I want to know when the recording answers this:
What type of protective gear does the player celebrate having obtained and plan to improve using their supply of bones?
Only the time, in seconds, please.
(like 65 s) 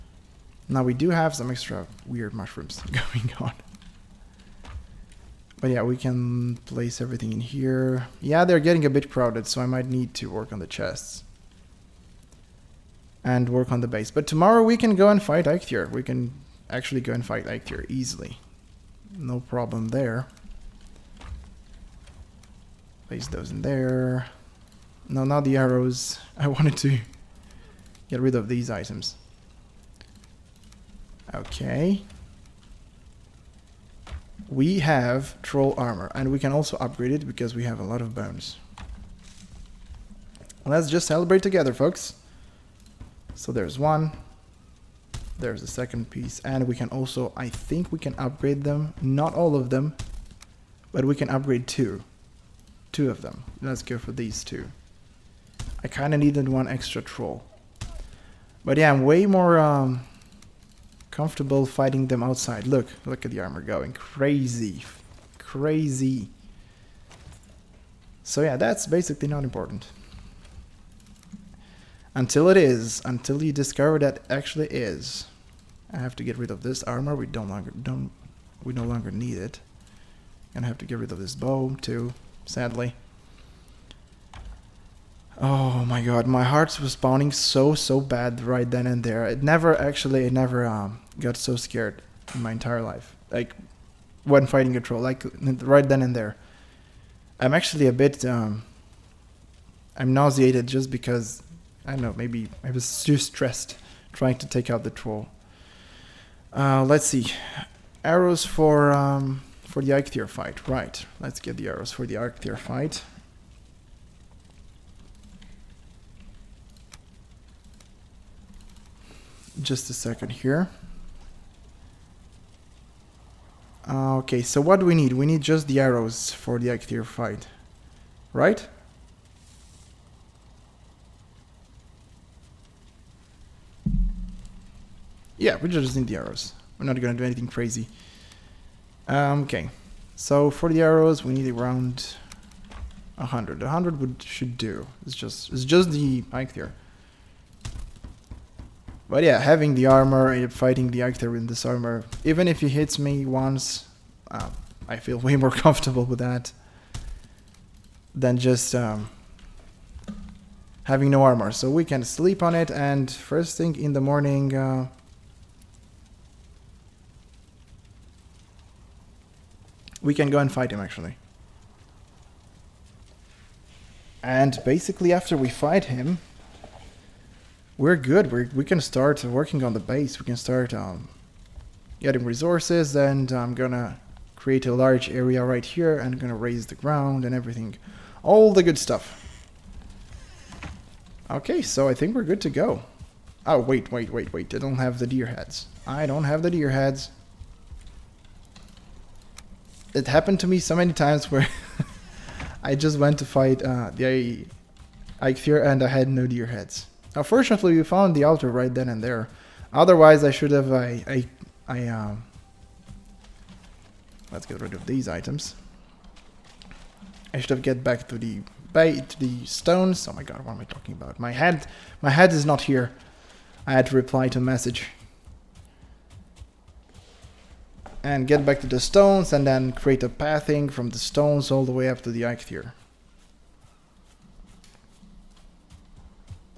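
35 s.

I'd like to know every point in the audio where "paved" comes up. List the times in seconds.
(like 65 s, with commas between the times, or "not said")
not said.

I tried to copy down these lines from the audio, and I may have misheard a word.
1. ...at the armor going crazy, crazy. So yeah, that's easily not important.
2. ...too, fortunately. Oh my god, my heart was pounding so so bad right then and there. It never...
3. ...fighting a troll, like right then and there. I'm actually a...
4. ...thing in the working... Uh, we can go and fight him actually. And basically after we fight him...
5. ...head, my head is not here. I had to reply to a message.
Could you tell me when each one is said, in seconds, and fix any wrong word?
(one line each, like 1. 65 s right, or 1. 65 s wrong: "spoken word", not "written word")
1. 63 s wrong: "basically", not "easily"
2. 81 s wrong: "sadly", not "fortunately"
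3. 94 s right
4. 163 s wrong: "morning", not "working"
5. 221 s right.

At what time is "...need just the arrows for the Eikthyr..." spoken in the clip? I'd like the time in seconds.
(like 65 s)
125 s.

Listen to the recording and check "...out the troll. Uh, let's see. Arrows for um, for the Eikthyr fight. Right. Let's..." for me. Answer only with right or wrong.
right.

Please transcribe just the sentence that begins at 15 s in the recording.
We can actually go and fight Eikthyr easily.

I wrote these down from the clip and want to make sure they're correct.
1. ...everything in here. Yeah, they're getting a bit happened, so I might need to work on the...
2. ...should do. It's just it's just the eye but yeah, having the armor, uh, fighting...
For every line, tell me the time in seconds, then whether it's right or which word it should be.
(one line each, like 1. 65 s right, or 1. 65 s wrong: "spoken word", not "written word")
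1. 7 s wrong: "crowded", not "happened"
2. 144 s right.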